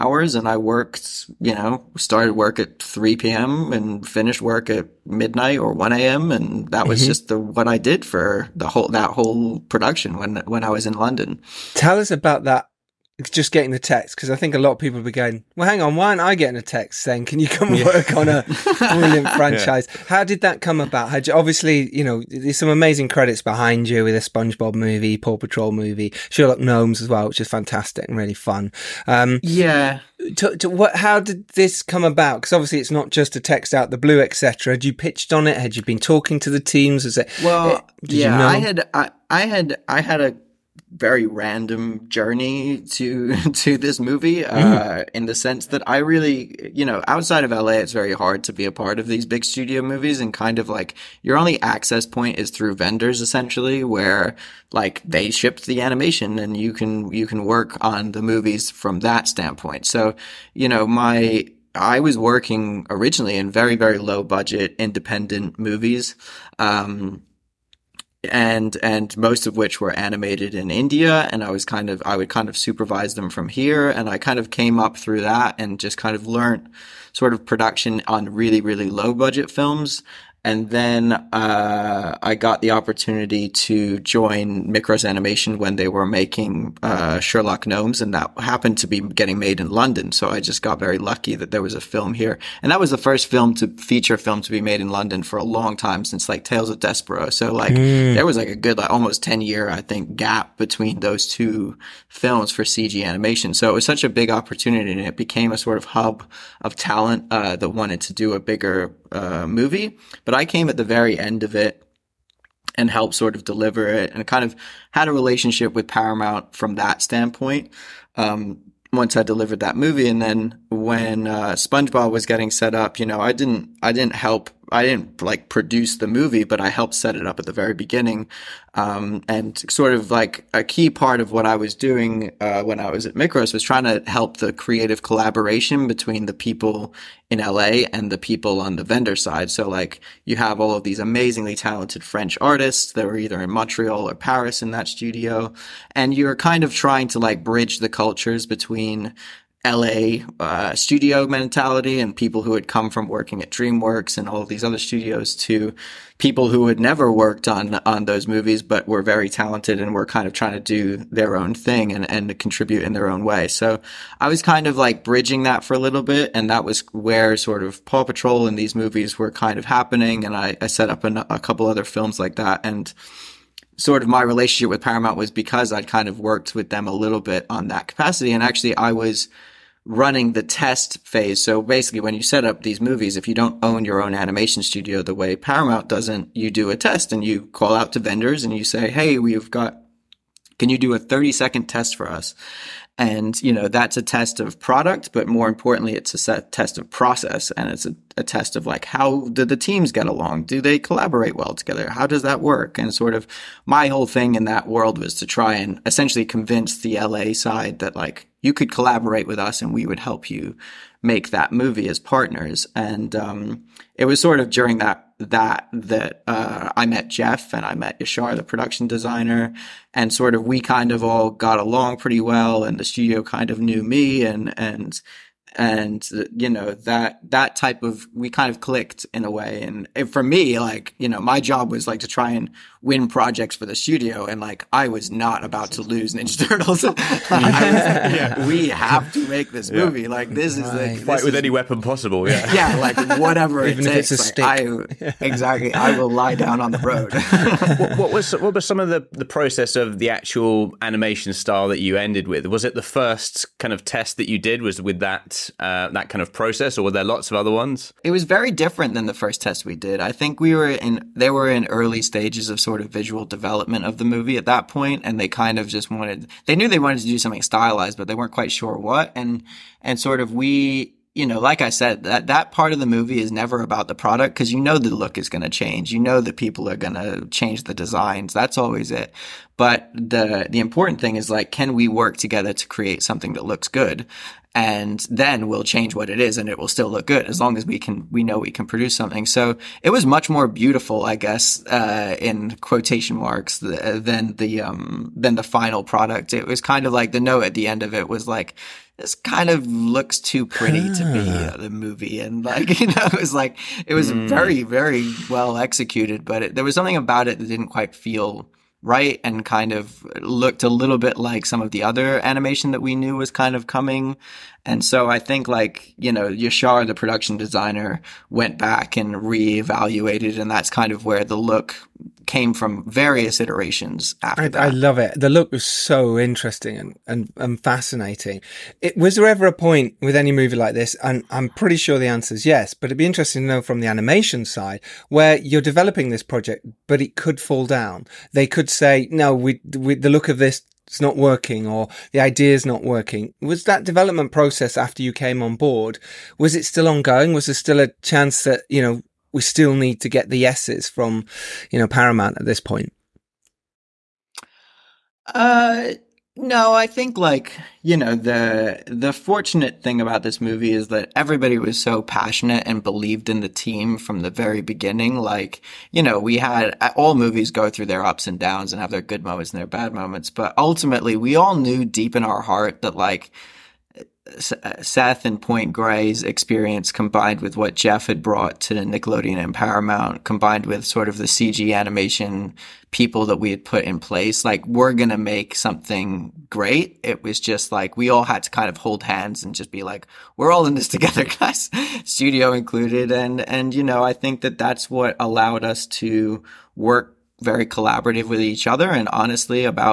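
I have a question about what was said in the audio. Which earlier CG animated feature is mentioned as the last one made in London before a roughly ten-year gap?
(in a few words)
Tales of Despereaux.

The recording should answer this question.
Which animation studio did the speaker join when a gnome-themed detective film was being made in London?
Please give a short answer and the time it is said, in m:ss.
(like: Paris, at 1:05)
Mikros Animation, at 1:24.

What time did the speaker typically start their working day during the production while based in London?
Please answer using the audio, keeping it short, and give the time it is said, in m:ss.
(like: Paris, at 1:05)
3 p.m., at 0:02.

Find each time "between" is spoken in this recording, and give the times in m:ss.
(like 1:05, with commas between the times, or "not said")
1:40, 2:15, 2:28.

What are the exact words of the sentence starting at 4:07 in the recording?
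what, what, was what was some of the the process of the actual animation style that you ended with?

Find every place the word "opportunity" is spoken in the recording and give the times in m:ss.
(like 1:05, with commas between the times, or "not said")
1:22, 1:44.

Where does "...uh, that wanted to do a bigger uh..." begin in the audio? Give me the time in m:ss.
1:47.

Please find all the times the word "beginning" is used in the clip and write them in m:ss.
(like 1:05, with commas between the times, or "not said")
2:07, 6:04.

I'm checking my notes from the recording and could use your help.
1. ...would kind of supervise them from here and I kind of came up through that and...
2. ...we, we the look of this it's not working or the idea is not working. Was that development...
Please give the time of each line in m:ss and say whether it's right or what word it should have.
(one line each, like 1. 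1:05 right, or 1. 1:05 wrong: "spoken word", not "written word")
1. 1:12 right
2. 5:39 right.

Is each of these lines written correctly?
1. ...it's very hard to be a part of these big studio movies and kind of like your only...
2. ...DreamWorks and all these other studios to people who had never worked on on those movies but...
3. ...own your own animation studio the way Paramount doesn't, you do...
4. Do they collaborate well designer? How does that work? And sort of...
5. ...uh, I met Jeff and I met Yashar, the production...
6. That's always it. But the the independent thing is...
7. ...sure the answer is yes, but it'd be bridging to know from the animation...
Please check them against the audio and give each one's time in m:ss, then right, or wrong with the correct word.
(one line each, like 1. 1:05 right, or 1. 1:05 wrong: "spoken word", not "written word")
1. 0:47 right
2. 2:33 right
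3. 3:03 right
4. 3:20 wrong: "together", not "designer"
5. 3:36 right
6. 4:38 wrong: "important", not "independent"
7. 5:31 wrong: "interesting", not "bridging".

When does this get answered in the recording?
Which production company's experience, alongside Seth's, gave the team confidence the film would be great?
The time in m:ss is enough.
6:15.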